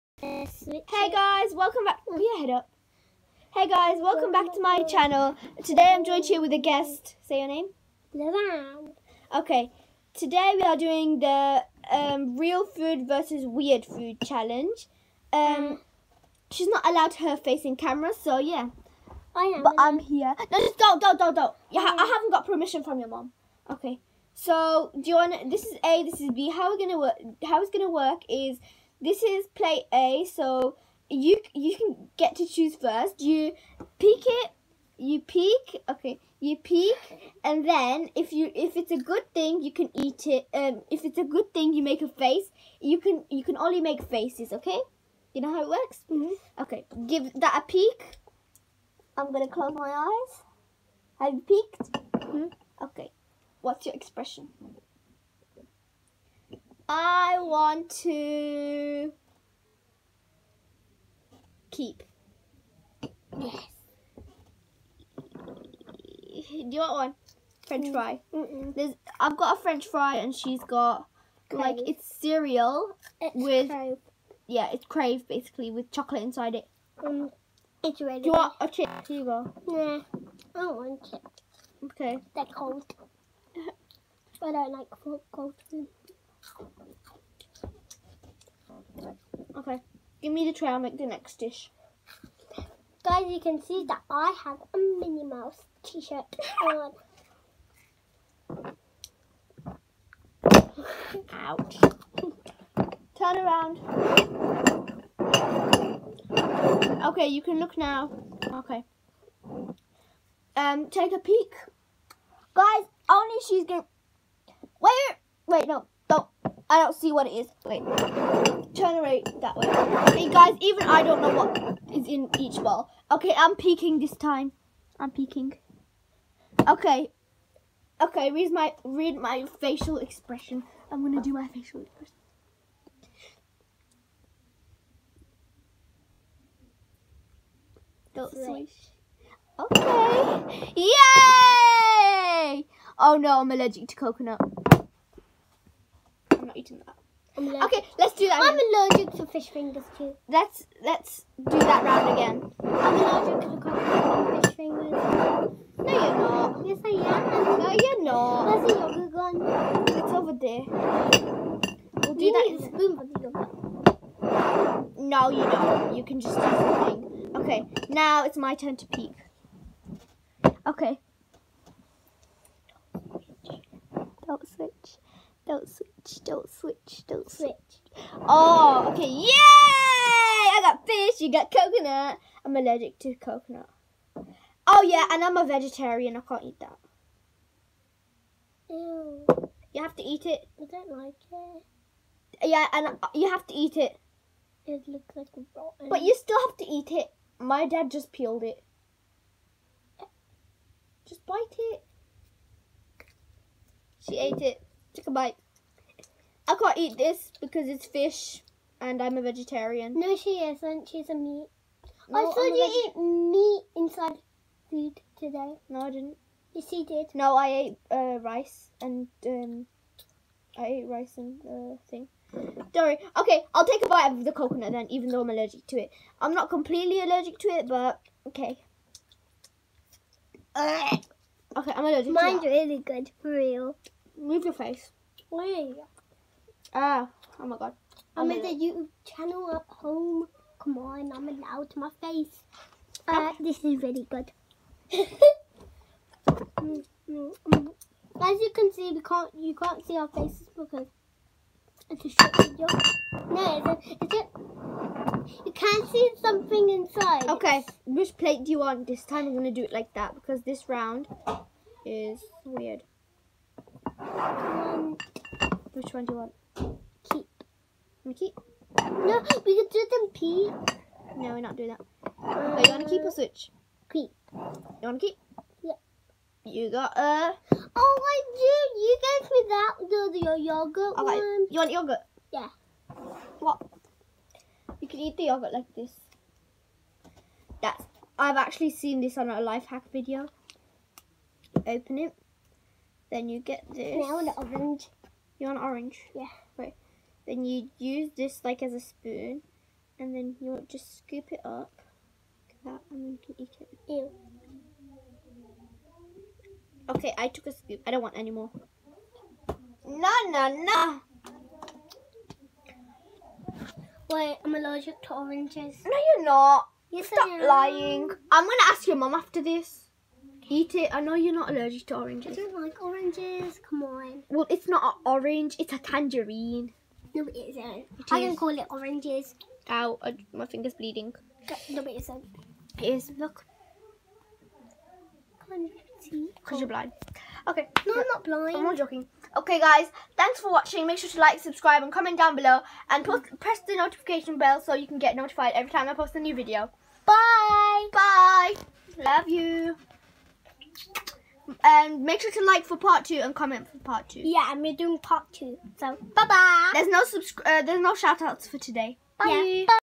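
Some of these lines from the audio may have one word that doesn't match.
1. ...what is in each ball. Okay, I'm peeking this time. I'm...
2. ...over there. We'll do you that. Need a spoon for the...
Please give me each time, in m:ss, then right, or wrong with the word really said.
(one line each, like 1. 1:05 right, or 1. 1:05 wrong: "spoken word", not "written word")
1. 2:01 right
2. 2:40 right.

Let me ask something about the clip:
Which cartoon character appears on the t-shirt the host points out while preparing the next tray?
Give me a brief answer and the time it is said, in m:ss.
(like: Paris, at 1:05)
Minnie Mouse, at 1:34.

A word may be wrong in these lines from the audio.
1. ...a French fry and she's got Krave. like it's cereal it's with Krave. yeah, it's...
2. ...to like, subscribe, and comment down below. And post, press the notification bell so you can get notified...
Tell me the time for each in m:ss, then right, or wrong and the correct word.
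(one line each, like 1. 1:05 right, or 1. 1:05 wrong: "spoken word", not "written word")
1. 1:09 right
2. 5:41 right.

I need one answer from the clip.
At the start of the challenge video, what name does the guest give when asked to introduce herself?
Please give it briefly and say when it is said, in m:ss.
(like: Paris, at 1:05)
Levan, at 0:08.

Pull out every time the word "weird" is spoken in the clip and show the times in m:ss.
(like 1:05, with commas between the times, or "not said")
0:13, 4:22.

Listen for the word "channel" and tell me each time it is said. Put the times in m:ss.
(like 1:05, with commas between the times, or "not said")
0:04, 3:59.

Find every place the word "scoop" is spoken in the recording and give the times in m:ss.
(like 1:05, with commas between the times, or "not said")
5:00, 5:07.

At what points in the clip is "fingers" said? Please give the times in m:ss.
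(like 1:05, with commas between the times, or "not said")
2:29, 2:34, 5:30.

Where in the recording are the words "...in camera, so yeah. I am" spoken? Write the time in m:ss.
0:17.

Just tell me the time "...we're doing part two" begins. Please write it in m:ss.
5:54.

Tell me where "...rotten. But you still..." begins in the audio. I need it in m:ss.
3:15.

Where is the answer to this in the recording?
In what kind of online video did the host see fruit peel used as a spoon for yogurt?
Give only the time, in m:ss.
4:49.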